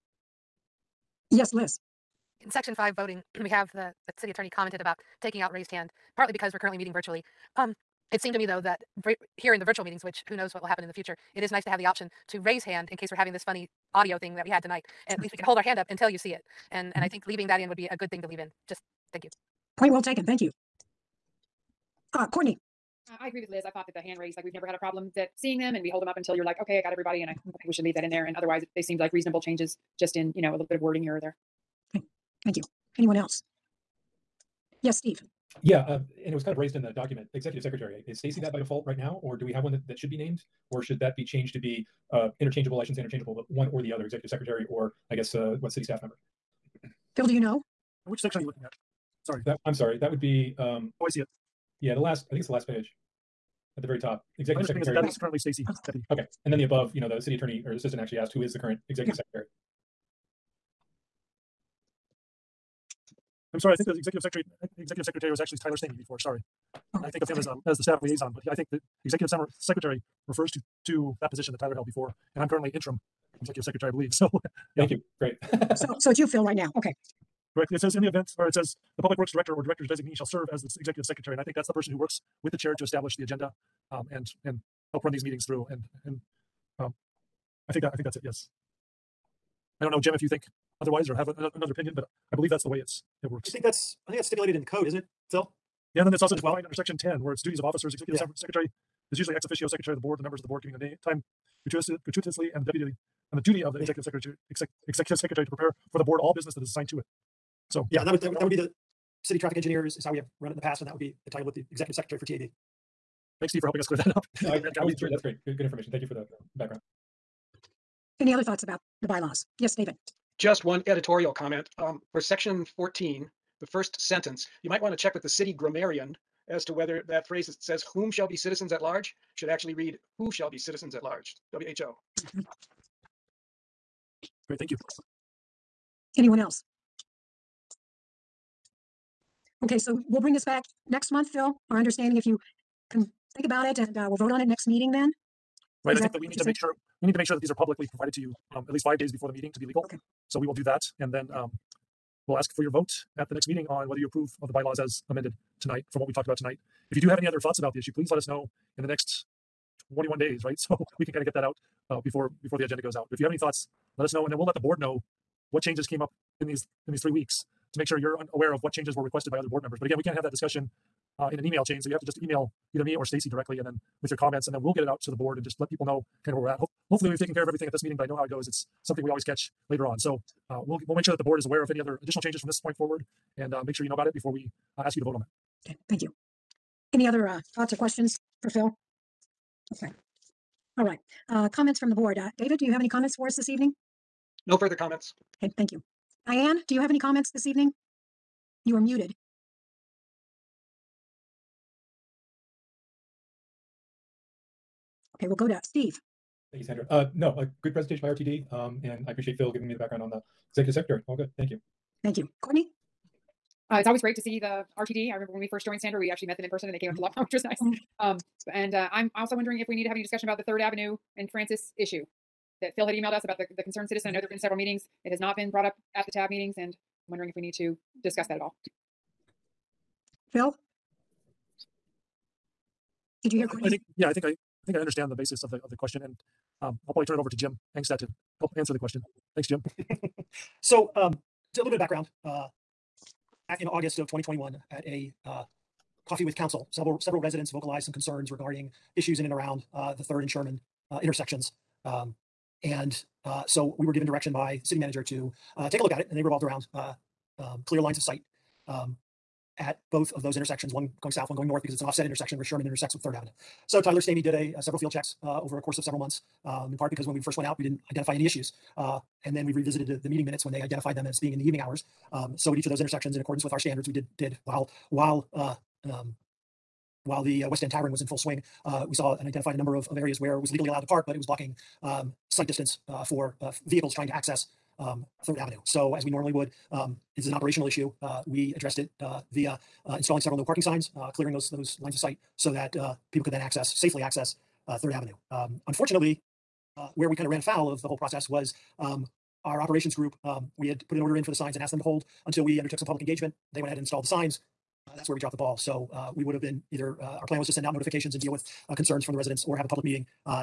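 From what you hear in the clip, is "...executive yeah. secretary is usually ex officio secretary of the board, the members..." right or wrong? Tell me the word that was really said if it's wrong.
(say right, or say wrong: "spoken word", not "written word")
right.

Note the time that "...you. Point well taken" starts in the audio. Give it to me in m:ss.
0:19.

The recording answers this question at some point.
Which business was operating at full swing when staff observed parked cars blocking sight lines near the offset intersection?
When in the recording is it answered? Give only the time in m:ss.
4:37.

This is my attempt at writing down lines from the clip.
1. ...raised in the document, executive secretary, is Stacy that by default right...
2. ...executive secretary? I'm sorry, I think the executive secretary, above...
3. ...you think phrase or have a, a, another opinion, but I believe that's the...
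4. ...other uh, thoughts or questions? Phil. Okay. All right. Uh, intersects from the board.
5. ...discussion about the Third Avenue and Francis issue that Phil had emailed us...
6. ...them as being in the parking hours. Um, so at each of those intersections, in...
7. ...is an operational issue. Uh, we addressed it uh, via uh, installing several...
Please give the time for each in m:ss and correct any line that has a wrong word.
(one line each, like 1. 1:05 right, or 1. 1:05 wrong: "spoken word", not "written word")
1. 0:36 right
2. 0:58 wrong: "executive", not "above"
3. 1:30 wrong: "otherwise", not "phrase"
4. 3:07 wrong: "comments", not "intersects"
5. 3:40 right
6. 4:30 wrong: "evening", not "parking"
7. 4:47 right.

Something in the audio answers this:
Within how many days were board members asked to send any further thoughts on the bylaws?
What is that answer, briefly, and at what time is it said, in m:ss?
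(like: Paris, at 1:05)
21, at 2:39.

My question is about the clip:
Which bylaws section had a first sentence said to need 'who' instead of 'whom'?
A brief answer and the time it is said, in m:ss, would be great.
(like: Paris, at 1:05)
Section 14, at 2:02.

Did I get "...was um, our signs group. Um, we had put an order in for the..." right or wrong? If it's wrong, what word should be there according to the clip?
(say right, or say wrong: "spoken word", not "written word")
wrong: "operations", not "signs".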